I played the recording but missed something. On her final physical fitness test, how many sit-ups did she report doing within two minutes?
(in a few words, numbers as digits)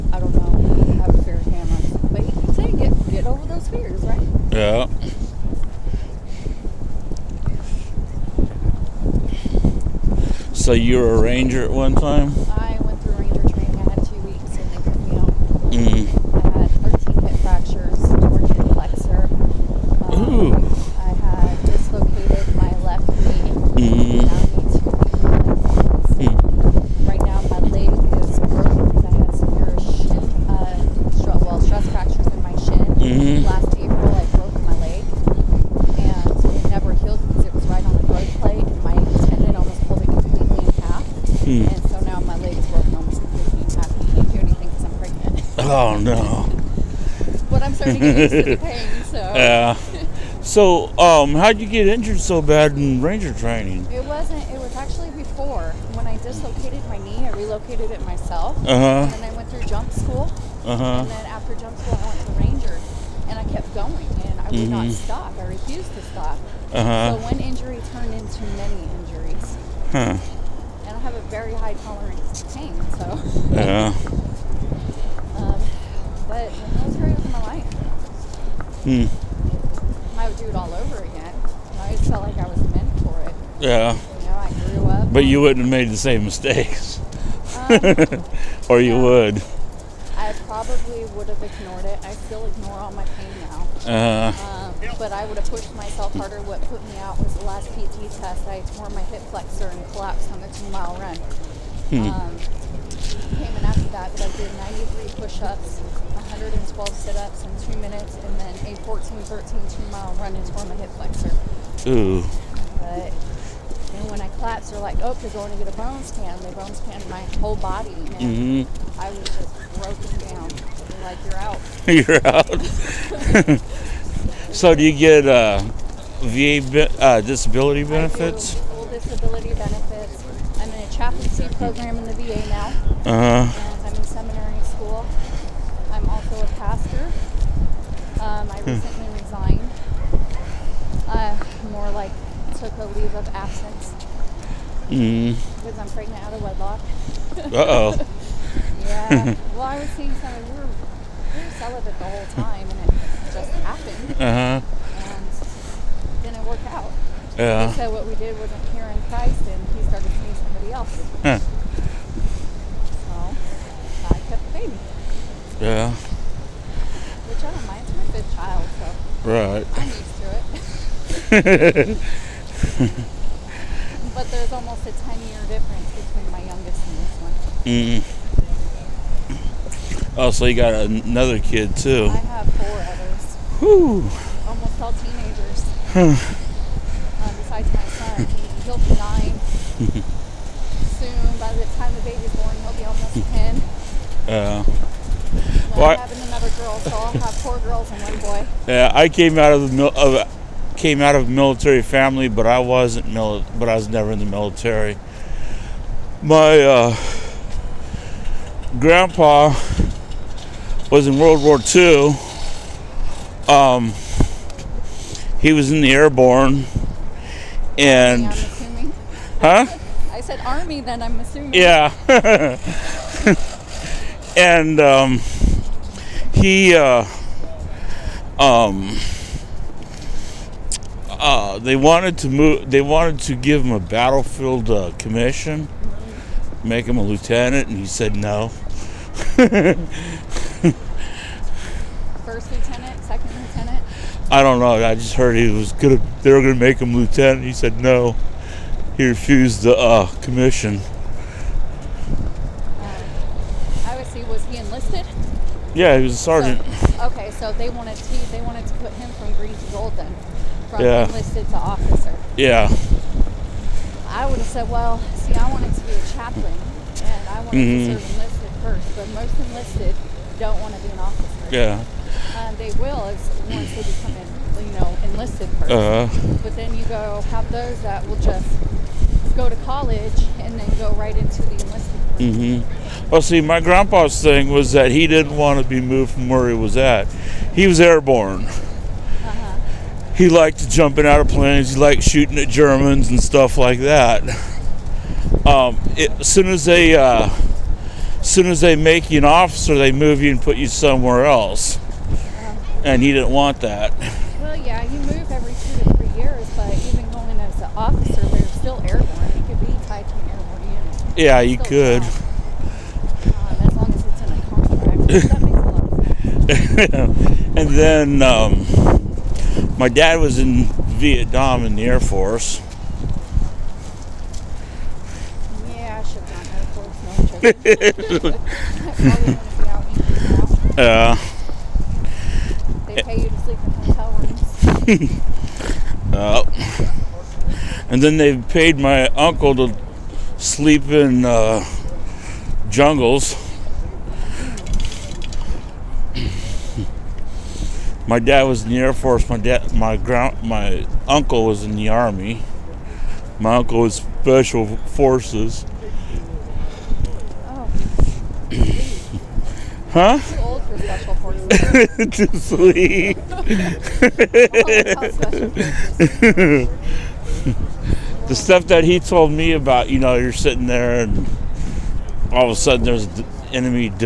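112.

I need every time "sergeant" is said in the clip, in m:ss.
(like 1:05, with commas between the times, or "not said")
4:16.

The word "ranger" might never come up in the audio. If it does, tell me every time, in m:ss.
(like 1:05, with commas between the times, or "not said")
0:11, 0:53, 1:02.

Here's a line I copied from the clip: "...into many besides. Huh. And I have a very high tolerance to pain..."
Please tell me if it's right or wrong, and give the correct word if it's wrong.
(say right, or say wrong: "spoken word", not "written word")
wrong: "injuries", not "besides".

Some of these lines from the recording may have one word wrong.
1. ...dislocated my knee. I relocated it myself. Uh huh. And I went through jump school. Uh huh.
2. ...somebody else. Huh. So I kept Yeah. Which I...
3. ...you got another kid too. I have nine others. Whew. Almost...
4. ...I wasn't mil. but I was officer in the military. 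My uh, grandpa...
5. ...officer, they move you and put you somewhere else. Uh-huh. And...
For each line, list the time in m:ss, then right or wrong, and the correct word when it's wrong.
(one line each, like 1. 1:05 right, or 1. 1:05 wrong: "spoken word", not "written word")
1. 0:56 right
2. 2:40 right
3. 3:00 wrong: "four", not "nine"
4. 3:22 wrong: "never", not "officer"
5. 4:59 right.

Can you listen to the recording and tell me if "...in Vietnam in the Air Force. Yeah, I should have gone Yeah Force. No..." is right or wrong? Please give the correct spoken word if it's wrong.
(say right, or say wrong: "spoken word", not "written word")
wrong: "Air", not "Yeah".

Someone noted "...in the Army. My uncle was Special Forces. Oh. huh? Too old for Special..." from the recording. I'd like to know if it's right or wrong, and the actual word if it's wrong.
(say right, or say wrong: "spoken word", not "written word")
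right.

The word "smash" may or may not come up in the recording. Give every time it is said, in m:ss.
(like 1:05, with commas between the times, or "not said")
not said.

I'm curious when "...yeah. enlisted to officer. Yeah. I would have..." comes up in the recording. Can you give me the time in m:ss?
4:20.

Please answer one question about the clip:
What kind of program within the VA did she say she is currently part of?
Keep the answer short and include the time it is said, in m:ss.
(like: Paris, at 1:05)
Chaplaincy program, at 2:10.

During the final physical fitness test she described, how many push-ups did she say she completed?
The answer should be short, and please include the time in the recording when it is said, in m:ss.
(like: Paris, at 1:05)
93, at 1:45.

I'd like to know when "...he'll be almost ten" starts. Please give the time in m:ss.
3:12.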